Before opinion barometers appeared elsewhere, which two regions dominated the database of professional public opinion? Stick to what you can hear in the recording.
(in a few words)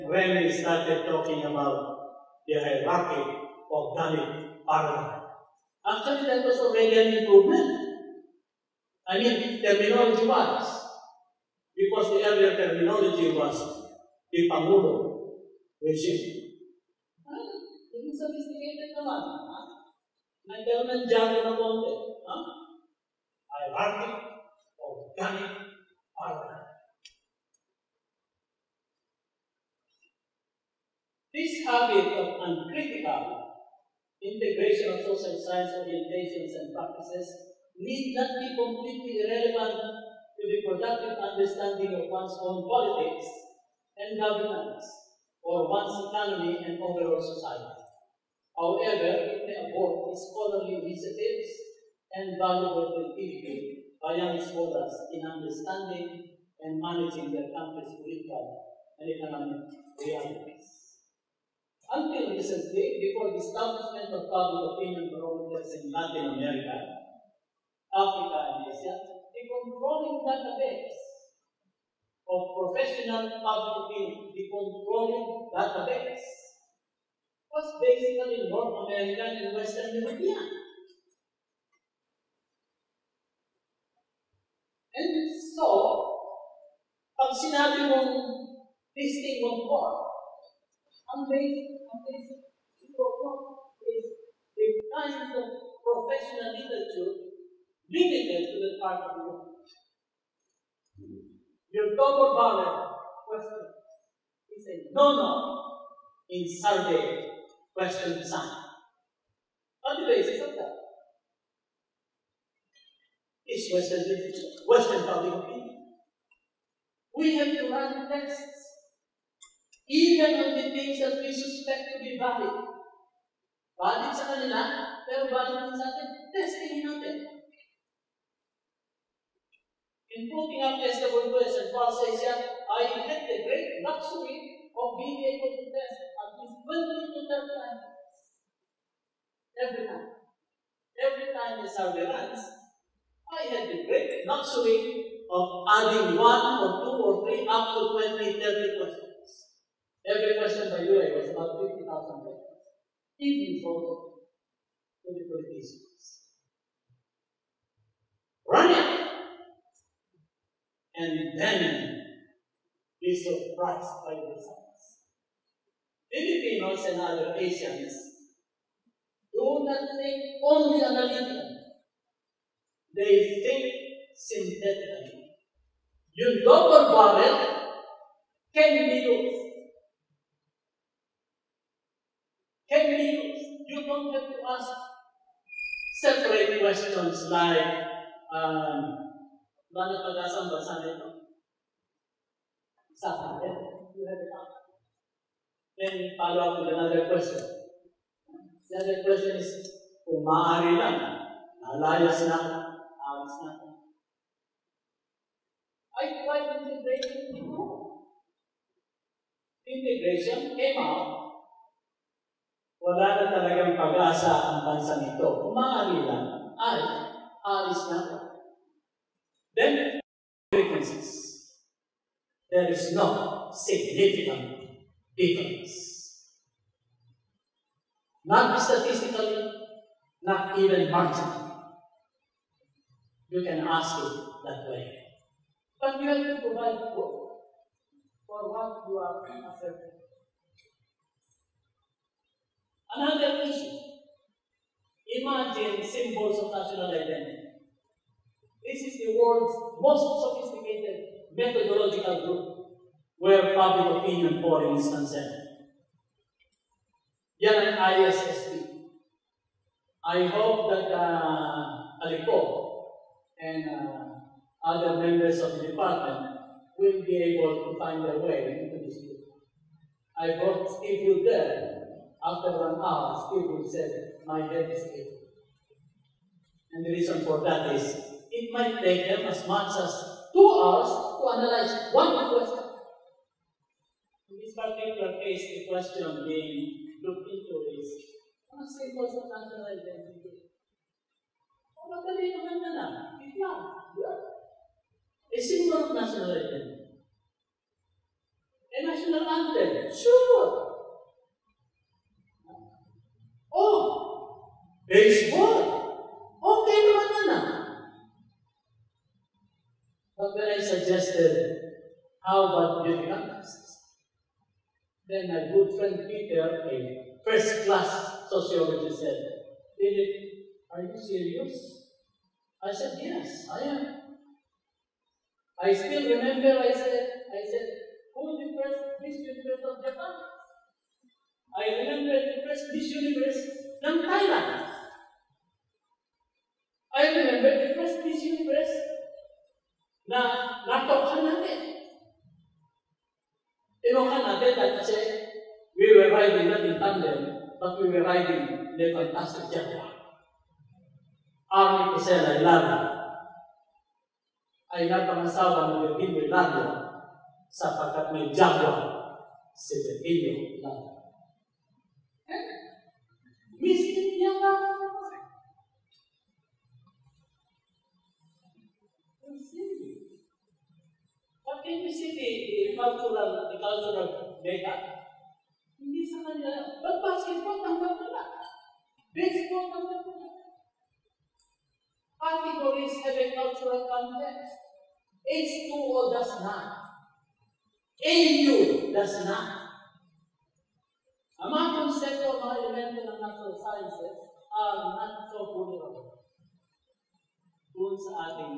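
North American and Western European.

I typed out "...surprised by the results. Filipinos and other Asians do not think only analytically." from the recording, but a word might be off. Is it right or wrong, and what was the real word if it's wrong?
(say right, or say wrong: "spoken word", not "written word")
right.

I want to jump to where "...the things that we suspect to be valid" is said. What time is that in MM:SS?
02:00.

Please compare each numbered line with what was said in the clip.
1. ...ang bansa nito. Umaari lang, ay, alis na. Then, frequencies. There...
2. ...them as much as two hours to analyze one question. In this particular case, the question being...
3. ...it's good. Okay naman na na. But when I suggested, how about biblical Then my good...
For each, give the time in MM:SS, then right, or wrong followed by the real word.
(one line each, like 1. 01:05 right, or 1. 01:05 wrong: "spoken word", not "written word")
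1. 03:34 right
2. 04:39 right
3. 05:04 right.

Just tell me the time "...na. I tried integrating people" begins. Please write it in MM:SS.
03:23.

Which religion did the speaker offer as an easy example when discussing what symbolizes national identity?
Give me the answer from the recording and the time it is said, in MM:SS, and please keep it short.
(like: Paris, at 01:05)
Islam, at 04:53.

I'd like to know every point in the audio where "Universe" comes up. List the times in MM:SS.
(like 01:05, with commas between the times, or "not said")
05:32, 05:38.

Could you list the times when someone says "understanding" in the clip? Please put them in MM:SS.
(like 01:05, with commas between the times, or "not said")
00:41, 00:55.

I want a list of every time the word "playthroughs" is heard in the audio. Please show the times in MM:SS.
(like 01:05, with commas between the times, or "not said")
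not said.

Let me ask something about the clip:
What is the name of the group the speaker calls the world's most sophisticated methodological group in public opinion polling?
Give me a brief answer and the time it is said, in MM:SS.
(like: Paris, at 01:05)
ISSP, at 04:17.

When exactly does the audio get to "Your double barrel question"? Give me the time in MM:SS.
01:41.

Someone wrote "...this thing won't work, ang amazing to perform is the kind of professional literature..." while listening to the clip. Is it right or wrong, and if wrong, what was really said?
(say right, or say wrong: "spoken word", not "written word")
right.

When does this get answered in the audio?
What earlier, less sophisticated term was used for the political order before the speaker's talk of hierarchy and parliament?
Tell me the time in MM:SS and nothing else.
00:14.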